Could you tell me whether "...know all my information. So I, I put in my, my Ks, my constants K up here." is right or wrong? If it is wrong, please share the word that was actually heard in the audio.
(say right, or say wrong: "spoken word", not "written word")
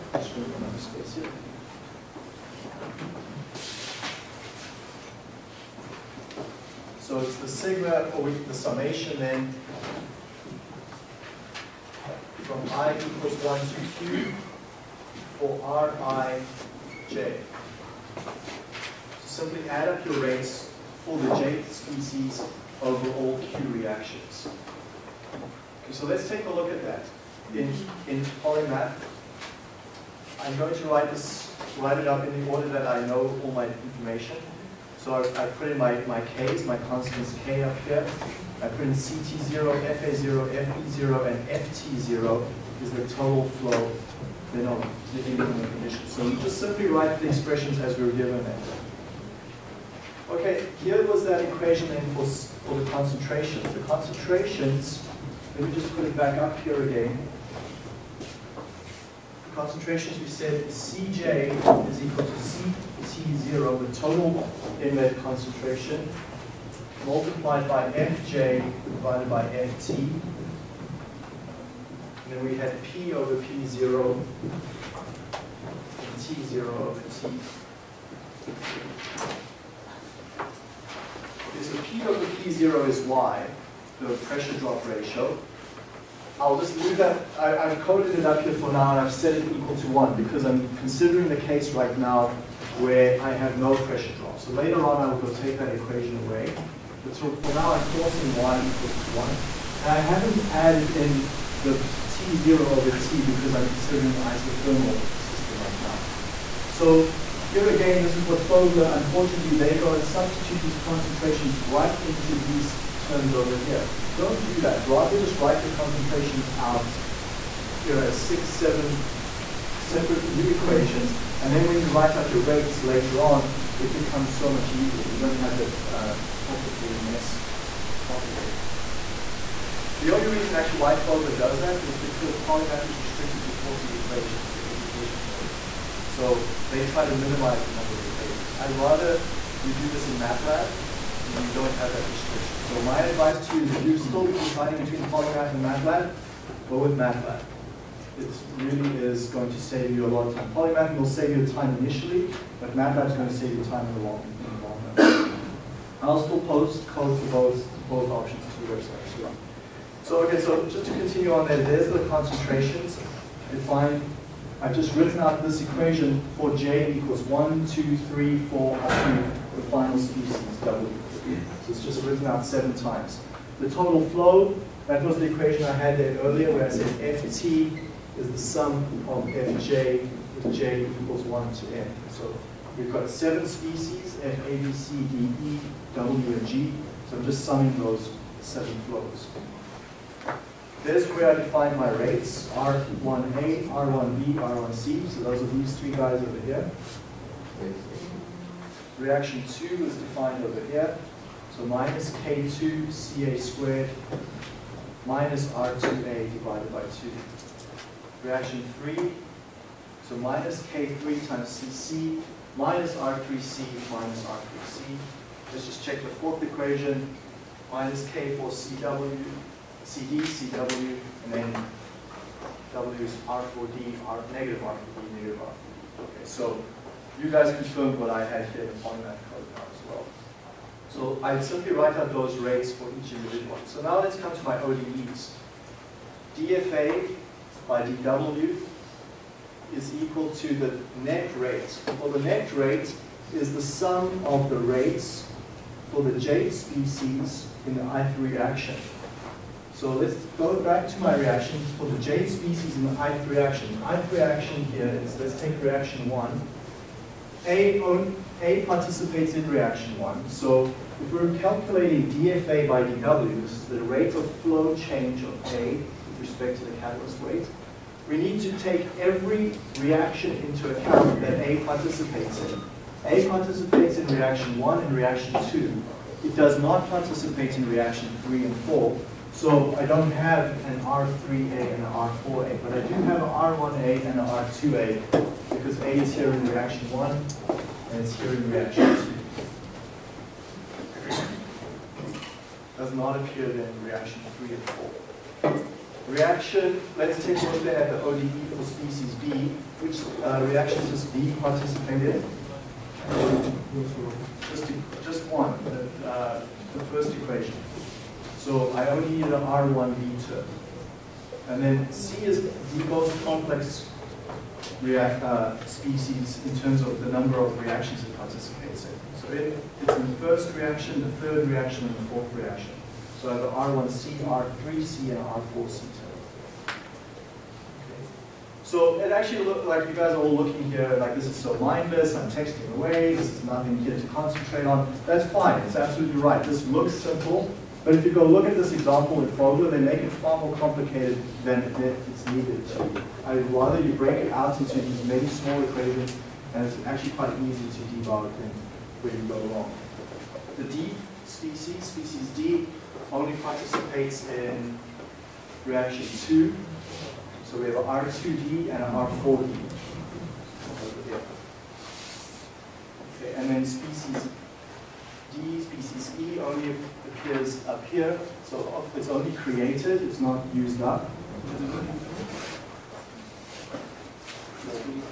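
right.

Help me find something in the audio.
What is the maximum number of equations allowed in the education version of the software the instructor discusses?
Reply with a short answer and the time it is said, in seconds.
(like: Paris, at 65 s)
40, at 133 s.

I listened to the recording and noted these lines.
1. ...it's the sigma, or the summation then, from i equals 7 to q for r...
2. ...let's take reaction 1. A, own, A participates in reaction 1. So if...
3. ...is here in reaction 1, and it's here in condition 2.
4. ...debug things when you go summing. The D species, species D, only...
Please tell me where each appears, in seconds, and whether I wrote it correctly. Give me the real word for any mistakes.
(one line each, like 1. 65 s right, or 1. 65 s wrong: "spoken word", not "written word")
1. 7 s wrong: "1", not "7"
2. 255 s right
3. 285 s wrong: "reaction", not "condition"
4. 347 s wrong: "along", not "summing".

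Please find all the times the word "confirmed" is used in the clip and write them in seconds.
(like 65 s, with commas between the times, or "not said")
227 s.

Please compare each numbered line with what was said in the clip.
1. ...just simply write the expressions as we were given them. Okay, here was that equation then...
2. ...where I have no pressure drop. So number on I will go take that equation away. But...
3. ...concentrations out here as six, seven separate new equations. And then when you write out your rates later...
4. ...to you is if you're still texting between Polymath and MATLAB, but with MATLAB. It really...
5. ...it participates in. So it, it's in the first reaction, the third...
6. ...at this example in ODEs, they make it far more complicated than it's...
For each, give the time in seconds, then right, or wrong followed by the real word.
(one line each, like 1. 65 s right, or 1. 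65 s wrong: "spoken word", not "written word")
1. 46 s right
2. 92 s wrong: "later", not "number"
3. 115 s right
4. 143 s wrong: "deciding", not "texting"
5. 318 s right
6. 338 s wrong: "Fogler", not "ODEs".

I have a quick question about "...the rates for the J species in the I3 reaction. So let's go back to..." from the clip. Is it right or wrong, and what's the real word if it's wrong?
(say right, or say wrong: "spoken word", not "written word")
right.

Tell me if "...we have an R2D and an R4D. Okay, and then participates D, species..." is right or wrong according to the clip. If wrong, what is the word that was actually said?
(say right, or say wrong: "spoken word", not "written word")
wrong: "species", not "participates".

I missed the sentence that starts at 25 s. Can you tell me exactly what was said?
Okay, so let's take a look at that in, in polymath.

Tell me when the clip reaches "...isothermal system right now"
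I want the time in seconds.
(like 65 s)
104 s.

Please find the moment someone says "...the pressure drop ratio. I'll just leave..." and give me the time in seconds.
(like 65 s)
83 s.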